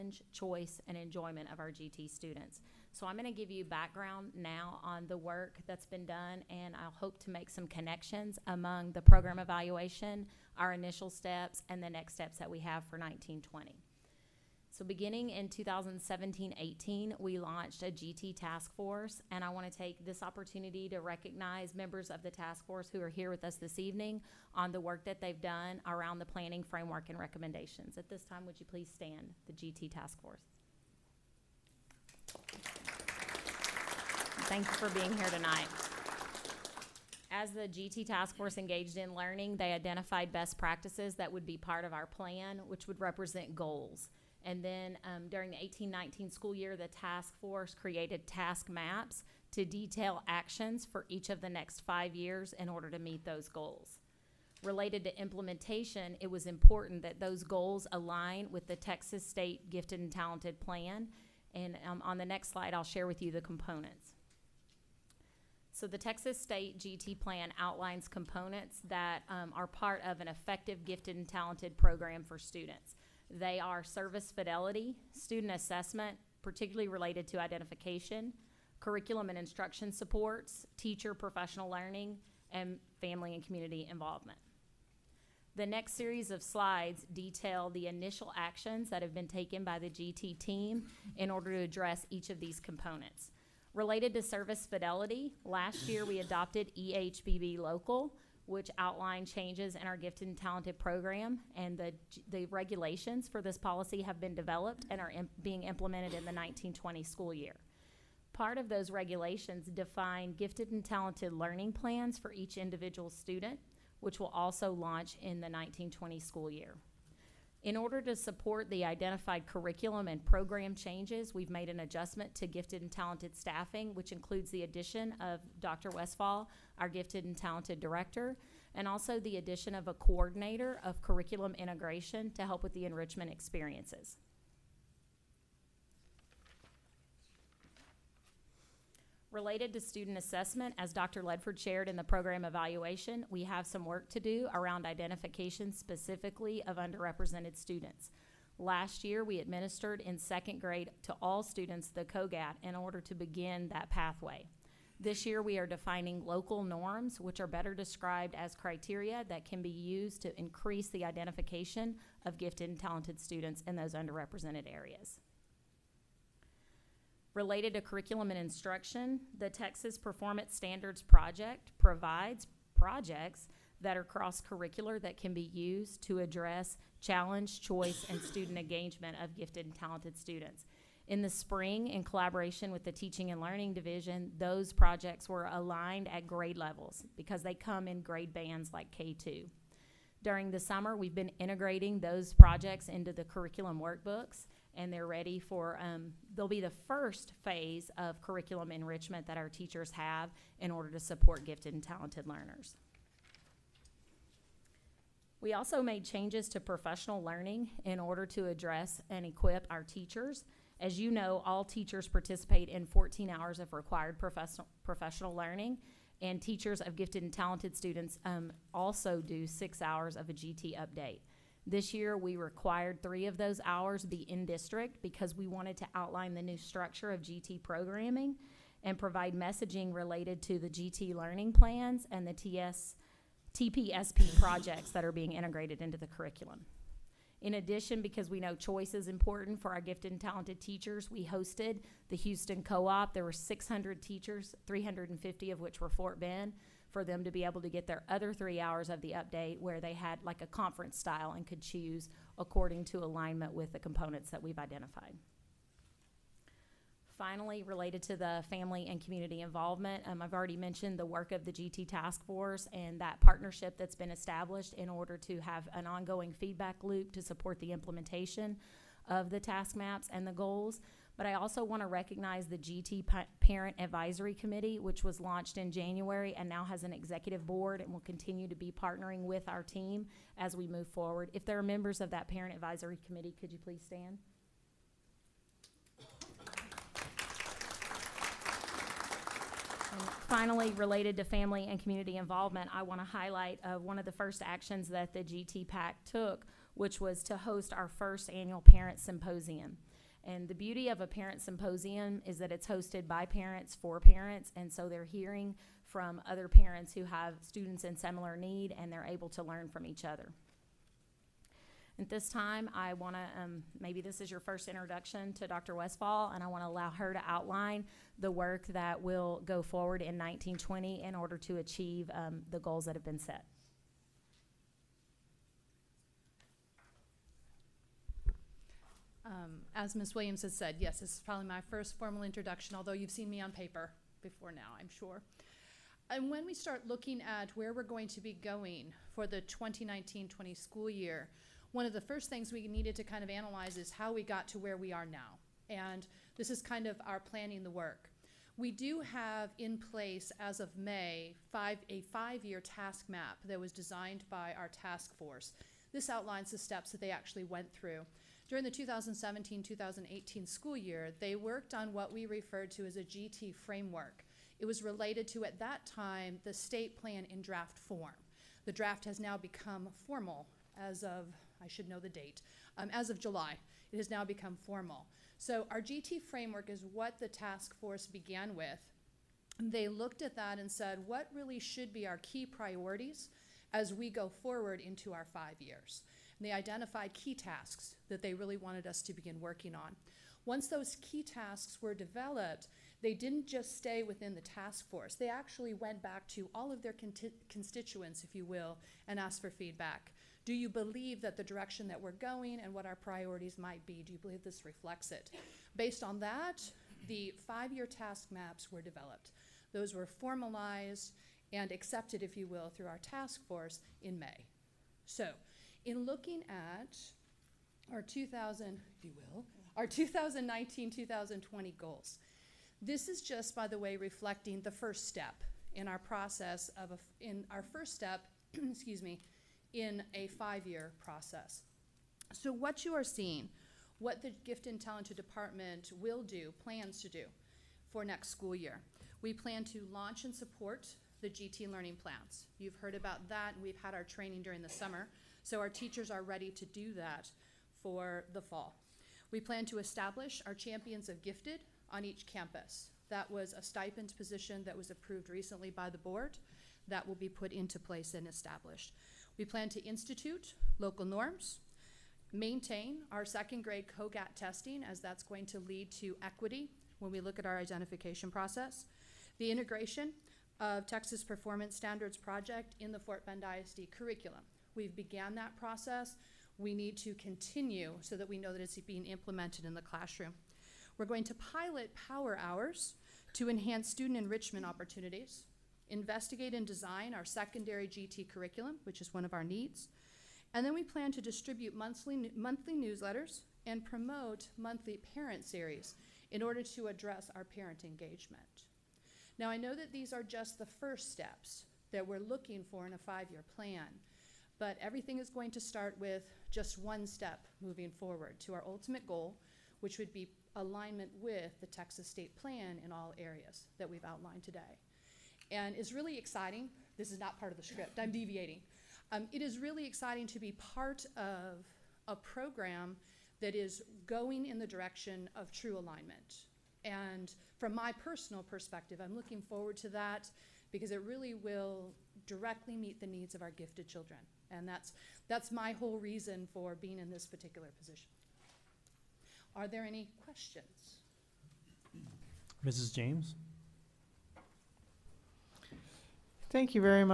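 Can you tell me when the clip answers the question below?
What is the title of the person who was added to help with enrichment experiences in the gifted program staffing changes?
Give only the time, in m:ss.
2:09.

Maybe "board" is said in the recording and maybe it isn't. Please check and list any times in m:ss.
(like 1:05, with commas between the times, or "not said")
4:37, 7:35.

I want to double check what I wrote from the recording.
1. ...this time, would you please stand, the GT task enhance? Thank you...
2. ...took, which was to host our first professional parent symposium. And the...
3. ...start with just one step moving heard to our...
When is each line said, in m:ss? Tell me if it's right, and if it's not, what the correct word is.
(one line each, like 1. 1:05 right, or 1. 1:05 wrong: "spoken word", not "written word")
1. 0:28 wrong: "force", not "enhance"
2. 4:56 wrong: "annual", not "professional"
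3. 8:25 wrong: "forward", not "heard".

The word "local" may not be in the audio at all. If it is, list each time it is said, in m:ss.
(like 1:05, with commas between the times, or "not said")
1:37, 2:36, 7:40.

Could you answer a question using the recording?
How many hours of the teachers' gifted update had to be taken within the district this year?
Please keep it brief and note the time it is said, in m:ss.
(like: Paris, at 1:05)
3, at 3:43.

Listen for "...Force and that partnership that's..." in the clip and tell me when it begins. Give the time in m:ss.
4:22.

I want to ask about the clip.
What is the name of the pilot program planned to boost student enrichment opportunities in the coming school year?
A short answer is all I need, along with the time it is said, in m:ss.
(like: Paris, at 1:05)
Power hours, at 8:02.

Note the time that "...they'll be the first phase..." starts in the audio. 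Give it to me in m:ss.
3:16.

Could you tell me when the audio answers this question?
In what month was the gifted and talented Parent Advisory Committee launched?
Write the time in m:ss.
4:35.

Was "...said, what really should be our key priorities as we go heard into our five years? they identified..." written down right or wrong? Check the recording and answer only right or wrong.
wrong.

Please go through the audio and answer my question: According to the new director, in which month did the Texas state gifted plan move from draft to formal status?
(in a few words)
July.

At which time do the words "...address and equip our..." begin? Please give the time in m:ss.
3:28.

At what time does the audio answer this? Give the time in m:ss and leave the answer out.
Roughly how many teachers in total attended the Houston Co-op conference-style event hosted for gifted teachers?
4:03.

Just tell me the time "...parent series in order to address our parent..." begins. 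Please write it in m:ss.
8:15.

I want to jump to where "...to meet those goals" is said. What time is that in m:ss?
0:52.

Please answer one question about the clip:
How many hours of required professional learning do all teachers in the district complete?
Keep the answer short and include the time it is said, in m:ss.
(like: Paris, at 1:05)
14, at 3:32.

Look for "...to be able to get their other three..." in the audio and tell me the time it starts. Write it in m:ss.
4:07.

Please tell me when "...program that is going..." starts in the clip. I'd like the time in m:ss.
8:42.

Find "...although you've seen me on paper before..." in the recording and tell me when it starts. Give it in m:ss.
5:32.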